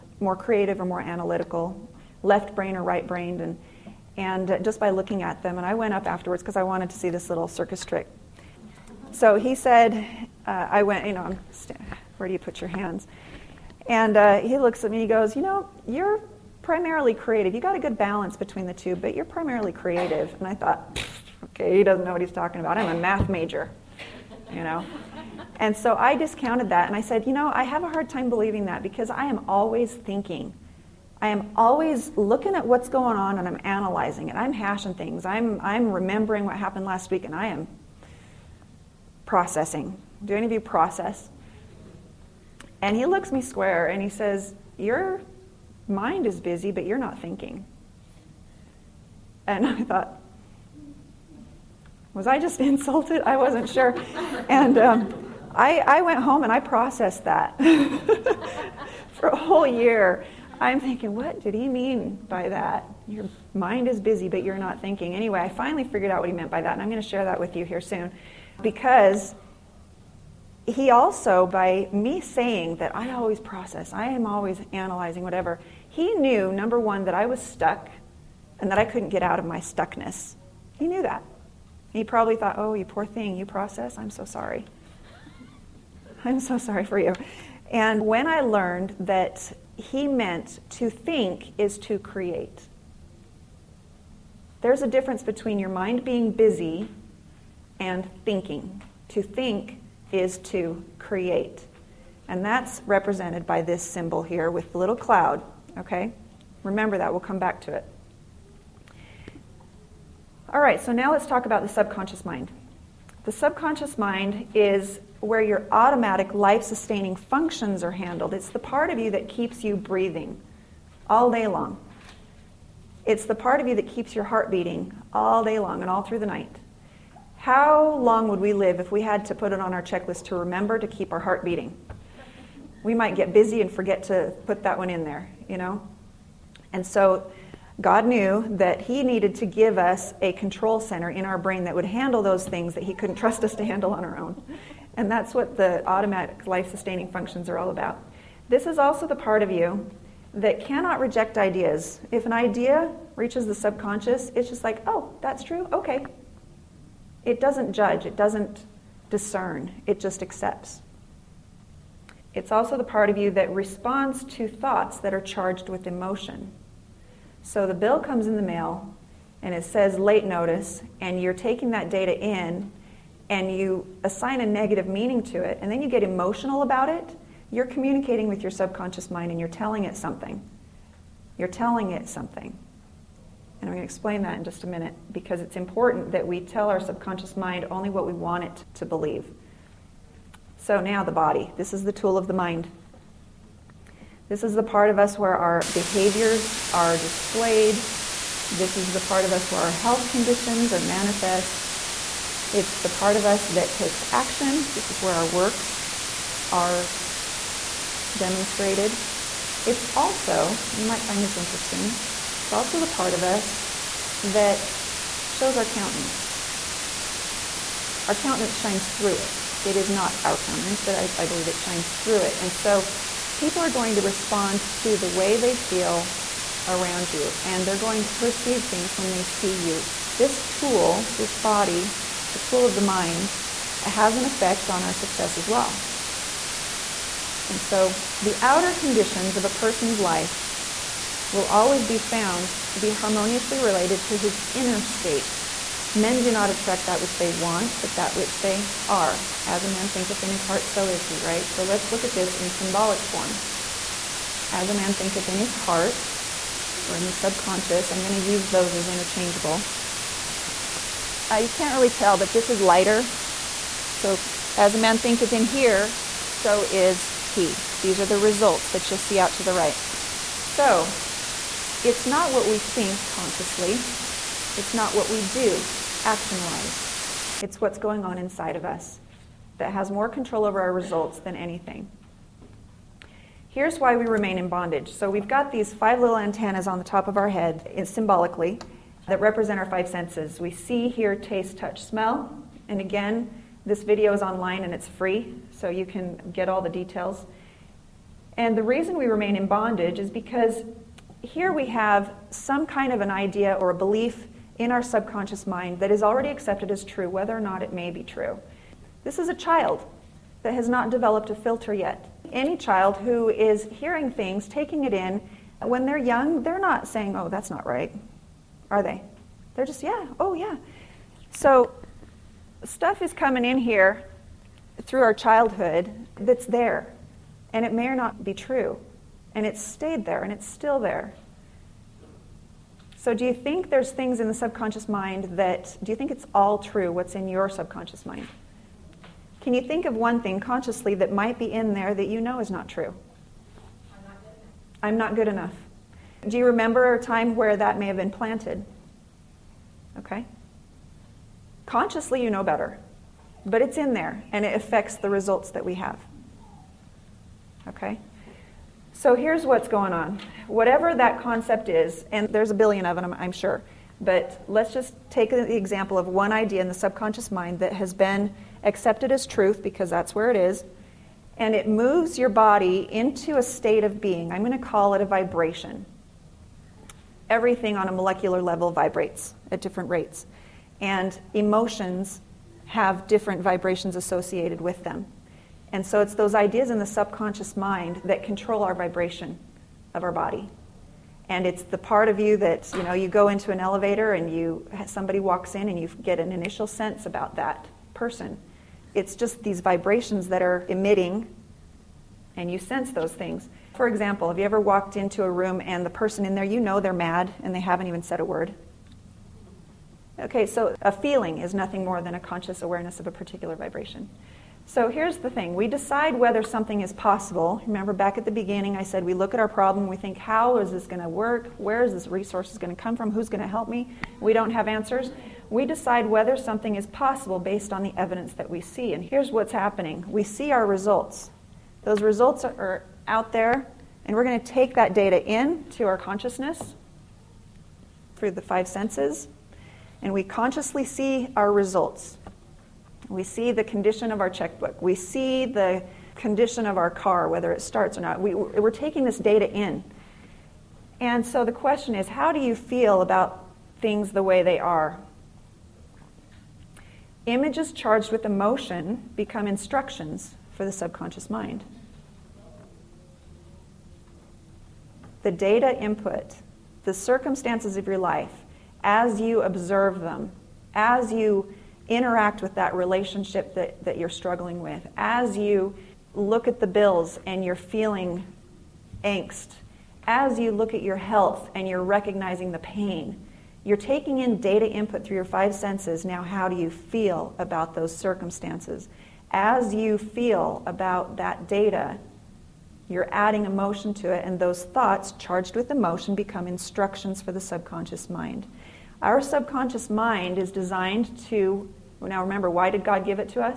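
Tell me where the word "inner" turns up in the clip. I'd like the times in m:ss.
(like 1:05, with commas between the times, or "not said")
4:04.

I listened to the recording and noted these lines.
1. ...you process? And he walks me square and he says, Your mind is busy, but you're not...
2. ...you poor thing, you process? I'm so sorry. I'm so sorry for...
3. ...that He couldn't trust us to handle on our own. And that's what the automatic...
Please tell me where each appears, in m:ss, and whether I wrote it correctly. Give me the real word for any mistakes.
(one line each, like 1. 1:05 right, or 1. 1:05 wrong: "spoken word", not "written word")
1. 0:40 wrong: "looks", not "walks"
2. 1:22 right
3. 2:22 right.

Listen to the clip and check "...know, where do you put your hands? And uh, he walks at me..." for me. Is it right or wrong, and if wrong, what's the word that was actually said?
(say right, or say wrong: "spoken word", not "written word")
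wrong: "looks", not "walks".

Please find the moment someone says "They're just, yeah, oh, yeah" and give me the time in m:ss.
5:19.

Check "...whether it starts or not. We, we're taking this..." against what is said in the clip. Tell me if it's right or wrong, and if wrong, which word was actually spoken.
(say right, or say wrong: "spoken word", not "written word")
right.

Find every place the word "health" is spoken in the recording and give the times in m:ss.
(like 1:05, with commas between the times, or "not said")
3:19, 8:00.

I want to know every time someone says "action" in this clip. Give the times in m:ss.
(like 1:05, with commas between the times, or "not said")
3:24, 4:36.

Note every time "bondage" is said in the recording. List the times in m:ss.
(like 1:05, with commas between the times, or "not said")
4:44, 4:59.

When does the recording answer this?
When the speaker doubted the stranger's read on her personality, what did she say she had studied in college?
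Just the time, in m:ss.
0:22.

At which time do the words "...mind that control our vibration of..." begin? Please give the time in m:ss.
6:27.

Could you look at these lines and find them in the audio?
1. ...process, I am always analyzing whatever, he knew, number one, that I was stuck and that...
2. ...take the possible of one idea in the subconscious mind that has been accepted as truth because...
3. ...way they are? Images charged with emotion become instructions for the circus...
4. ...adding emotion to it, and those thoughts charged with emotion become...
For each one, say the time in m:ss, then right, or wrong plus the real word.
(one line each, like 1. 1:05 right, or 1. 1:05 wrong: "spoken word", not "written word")
1. 1:13 right
2. 6:05 wrong: "example", not "possible"
3. 7:34 wrong: "subconscious", not "circus"
4. 8:13 right.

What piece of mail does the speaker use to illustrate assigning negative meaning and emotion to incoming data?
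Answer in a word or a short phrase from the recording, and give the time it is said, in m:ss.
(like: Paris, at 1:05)
late notice, at 2:49.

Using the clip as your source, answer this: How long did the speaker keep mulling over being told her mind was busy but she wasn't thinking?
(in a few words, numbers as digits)
a whole year.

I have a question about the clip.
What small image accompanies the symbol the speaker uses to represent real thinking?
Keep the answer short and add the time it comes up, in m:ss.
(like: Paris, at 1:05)
little cloud, at 1:44.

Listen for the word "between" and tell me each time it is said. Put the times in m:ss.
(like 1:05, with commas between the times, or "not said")
0:18, 1:35.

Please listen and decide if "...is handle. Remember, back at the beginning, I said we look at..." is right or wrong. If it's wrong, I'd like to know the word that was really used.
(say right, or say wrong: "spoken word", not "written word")
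wrong: "possible", not "handle".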